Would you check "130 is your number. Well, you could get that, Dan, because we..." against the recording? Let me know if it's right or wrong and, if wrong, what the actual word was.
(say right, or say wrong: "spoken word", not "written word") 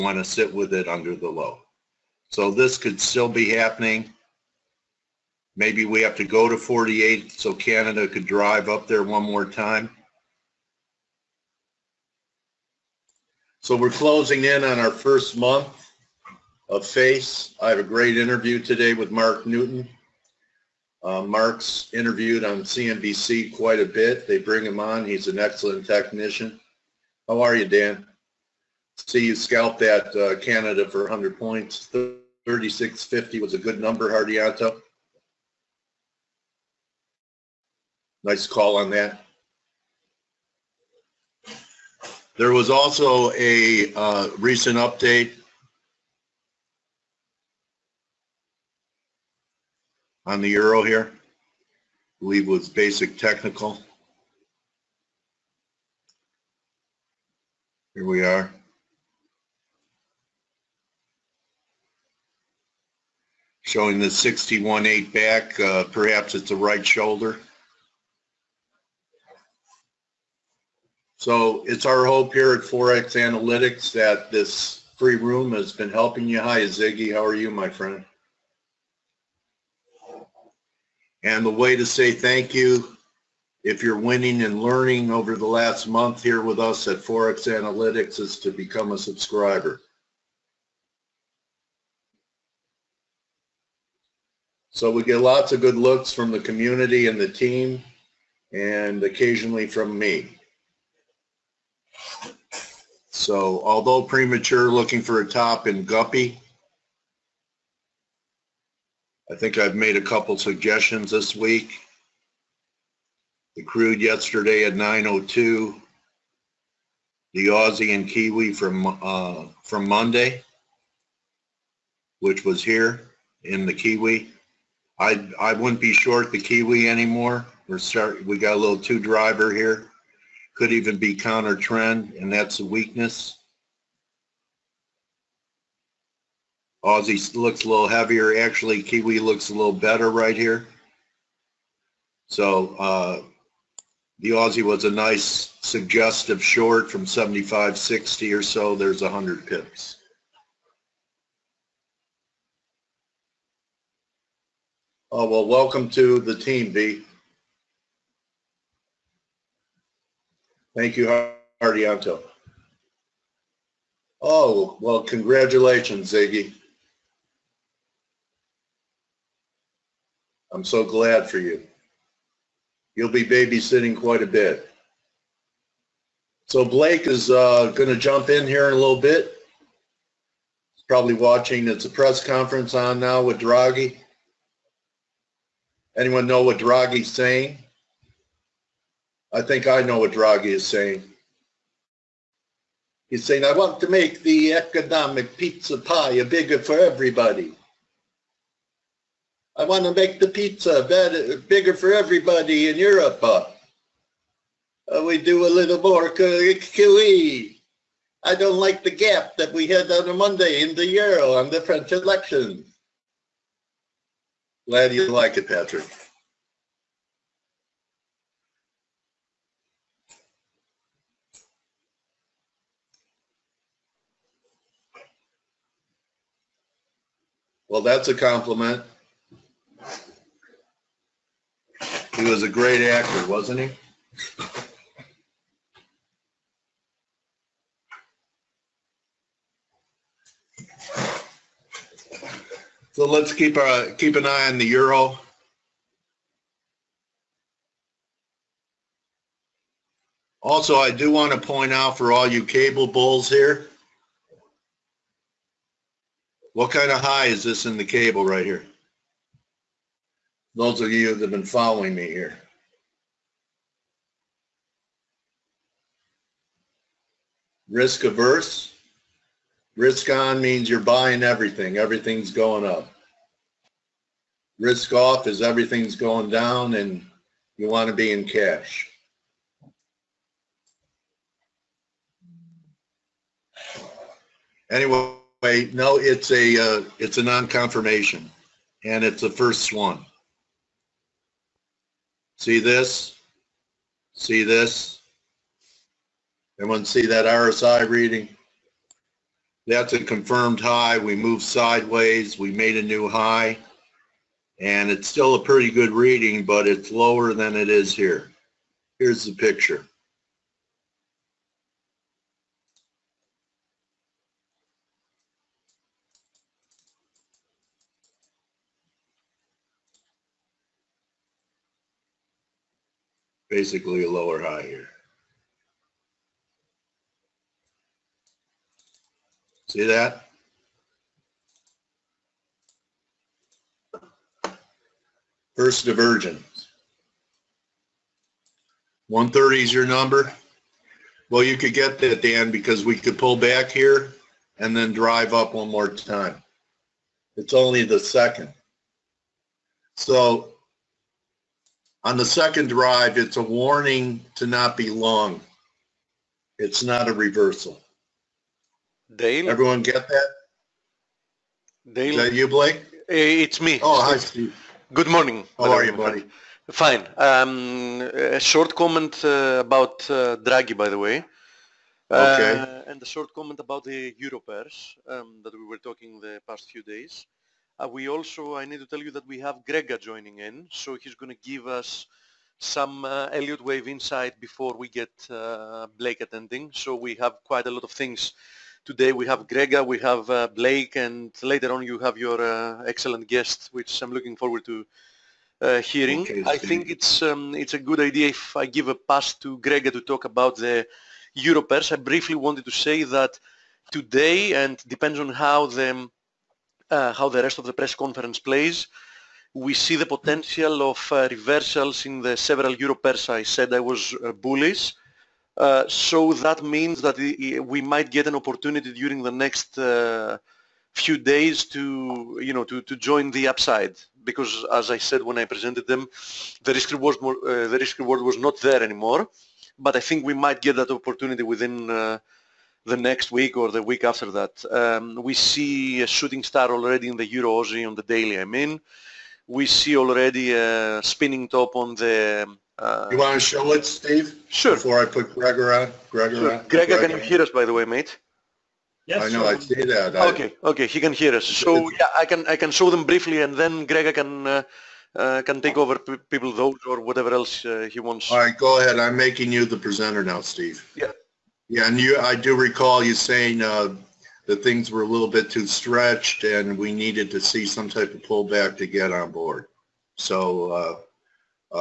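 right.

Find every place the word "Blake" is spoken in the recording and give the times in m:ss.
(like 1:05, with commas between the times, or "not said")
2:56, 6:02, 6:25, 6:30.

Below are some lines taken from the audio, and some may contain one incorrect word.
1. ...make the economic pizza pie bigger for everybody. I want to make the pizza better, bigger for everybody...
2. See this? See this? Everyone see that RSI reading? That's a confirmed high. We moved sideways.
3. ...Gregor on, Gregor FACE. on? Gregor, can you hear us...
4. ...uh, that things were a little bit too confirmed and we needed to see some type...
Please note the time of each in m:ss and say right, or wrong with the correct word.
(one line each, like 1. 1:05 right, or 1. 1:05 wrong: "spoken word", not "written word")
1. 3:13 right
2. 4:52 right
3. 7:25 wrong: "Sure", not "FACE"
4. 7:43 wrong: "stretched", not "confirmed".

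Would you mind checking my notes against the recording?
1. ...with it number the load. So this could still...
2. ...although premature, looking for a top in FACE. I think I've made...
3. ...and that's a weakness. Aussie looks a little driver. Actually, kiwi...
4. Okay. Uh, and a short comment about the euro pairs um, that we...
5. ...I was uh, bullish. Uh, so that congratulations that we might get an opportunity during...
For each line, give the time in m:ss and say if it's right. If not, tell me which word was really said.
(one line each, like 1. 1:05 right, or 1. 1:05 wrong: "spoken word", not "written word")
1. 0:00 wrong: "under", not "number"
2. 1:43 wrong: "Guppy", not "FACE"
3. 2:12 wrong: "heavier", not "driver"
4. 6:12 right
5. 6:53 wrong: "means", not "congratulations".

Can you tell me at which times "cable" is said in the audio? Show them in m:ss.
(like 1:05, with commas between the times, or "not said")
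4:12, 4:17.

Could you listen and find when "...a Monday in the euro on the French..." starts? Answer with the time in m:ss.
3:30.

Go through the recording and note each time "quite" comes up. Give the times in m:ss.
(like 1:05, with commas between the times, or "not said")
0:23, 2:53, 6:27.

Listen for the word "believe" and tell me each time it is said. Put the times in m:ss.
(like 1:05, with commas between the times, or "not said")
0:52.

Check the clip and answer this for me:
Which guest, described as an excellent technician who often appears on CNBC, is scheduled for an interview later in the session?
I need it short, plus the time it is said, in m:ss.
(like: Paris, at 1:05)
Mark Newton, at 0:19.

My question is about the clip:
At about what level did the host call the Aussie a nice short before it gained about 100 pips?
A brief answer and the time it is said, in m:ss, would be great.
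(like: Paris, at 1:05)
75.60, at 2:27.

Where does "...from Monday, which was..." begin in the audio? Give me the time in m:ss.
1:59.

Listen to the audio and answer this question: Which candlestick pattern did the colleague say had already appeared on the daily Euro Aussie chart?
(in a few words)
shooting star.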